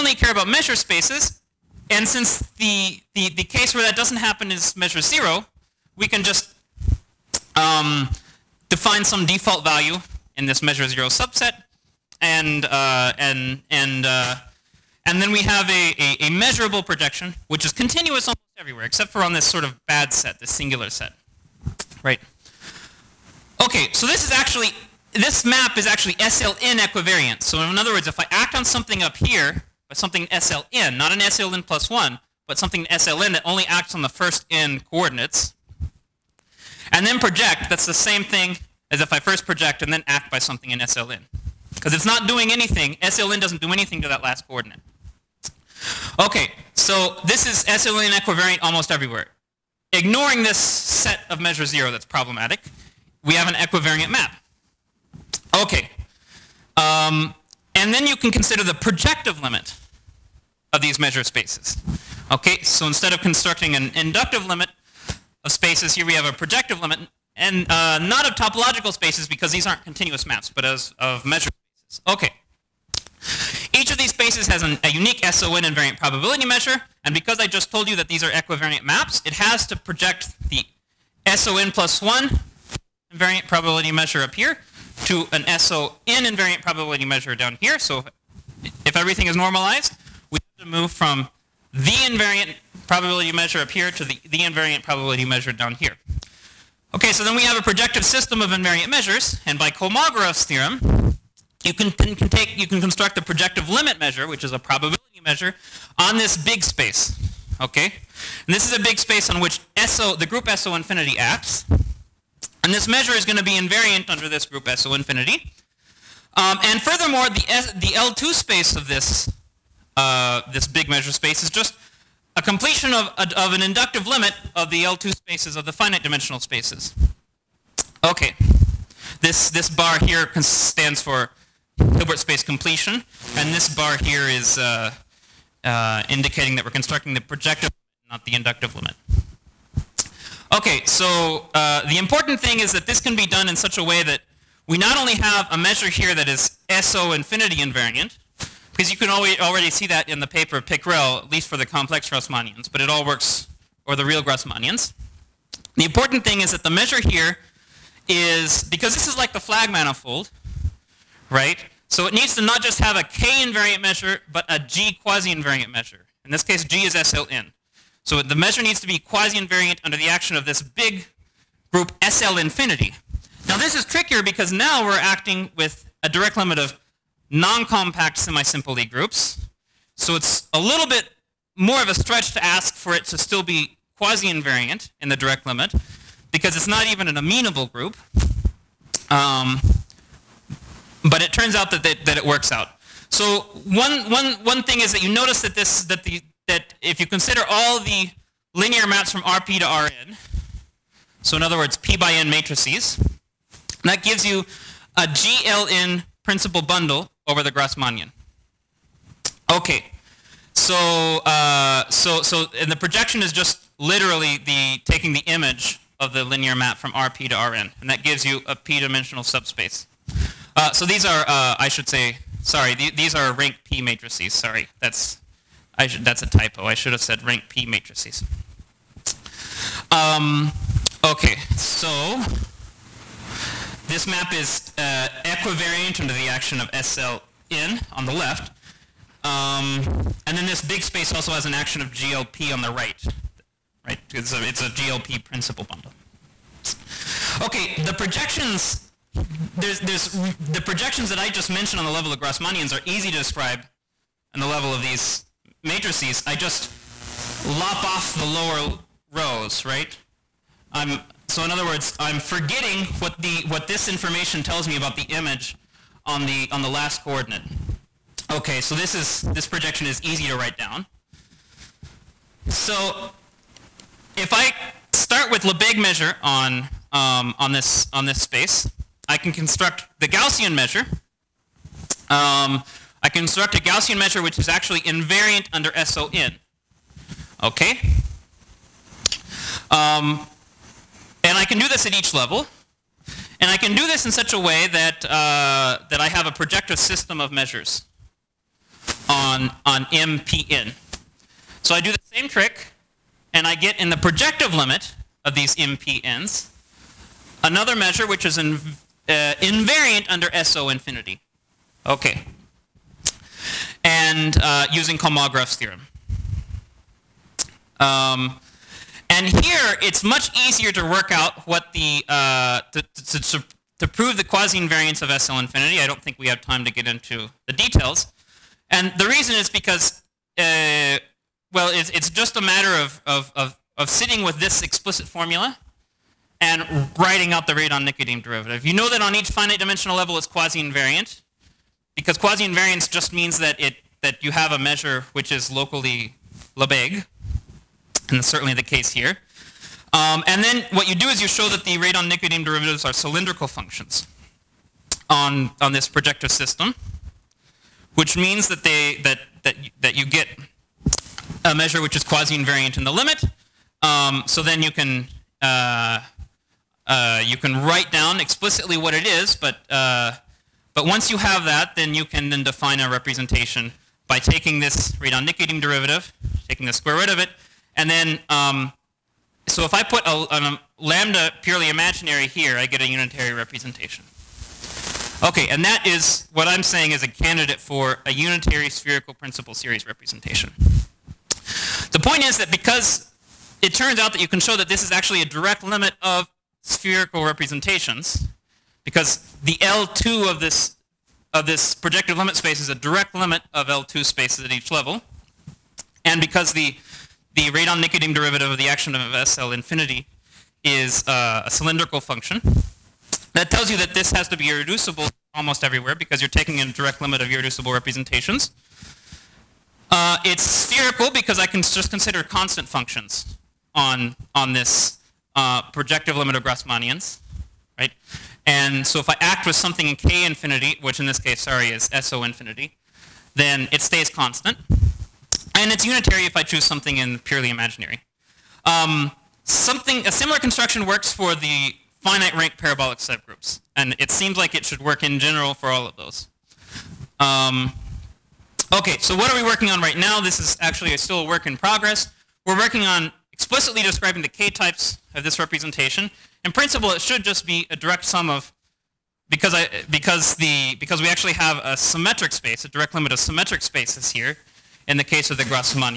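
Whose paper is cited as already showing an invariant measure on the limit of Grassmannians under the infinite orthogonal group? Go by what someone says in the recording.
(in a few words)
Pickrell.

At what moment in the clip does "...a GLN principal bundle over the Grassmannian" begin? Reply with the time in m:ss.
3:24.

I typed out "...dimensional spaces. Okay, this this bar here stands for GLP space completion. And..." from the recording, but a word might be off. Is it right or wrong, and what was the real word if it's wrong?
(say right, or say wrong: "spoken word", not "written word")
wrong: "Hilbert", not "GLP".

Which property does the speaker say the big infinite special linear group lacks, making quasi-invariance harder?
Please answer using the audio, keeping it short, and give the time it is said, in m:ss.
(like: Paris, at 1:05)
amenable, at 3:07.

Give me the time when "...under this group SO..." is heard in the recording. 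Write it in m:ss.
1:54.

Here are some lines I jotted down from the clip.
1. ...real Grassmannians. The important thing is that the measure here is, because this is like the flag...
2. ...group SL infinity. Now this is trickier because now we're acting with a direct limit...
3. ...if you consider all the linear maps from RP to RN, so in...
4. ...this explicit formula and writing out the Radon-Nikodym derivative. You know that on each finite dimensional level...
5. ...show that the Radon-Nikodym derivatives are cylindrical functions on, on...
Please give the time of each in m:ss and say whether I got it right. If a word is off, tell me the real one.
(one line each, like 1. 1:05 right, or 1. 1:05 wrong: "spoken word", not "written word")
1. 2:34 right
2. 2:51 right
3. 3:16 right
4. 5:34 right
5. 5:51 right.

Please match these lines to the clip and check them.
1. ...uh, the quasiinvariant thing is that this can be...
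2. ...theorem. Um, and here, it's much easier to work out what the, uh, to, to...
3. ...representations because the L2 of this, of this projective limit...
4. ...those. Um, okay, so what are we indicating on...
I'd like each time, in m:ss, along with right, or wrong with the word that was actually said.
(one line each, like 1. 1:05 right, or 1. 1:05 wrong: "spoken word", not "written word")
1. 2:21 wrong: "important", not "quasiinvariant"
2. 5:15 right
3. 6:37 right
4. 7:25 wrong: "working", not "indicating".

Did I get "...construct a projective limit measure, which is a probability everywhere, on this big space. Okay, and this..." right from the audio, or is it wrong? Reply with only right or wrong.
wrong.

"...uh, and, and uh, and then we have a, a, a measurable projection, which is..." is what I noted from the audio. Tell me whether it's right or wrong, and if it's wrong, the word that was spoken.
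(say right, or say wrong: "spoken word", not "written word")
right.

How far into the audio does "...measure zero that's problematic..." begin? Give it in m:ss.
0:51.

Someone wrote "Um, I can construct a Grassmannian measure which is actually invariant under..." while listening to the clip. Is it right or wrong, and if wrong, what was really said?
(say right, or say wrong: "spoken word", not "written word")
wrong: "Gaussian", not "Grassmannian".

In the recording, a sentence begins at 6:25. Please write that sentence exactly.
Okay, and that is what I'm saying is a candidate for a unitary spherical principal series representation.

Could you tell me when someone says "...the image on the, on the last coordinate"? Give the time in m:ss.
4:24.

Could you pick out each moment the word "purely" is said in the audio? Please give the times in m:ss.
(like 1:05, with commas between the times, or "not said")
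6:21, 7:17.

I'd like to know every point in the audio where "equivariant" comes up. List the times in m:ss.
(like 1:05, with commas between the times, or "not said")
0:26, 0:48, 0:53, 1:18, 3:55.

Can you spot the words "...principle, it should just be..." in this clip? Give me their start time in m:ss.
7:36.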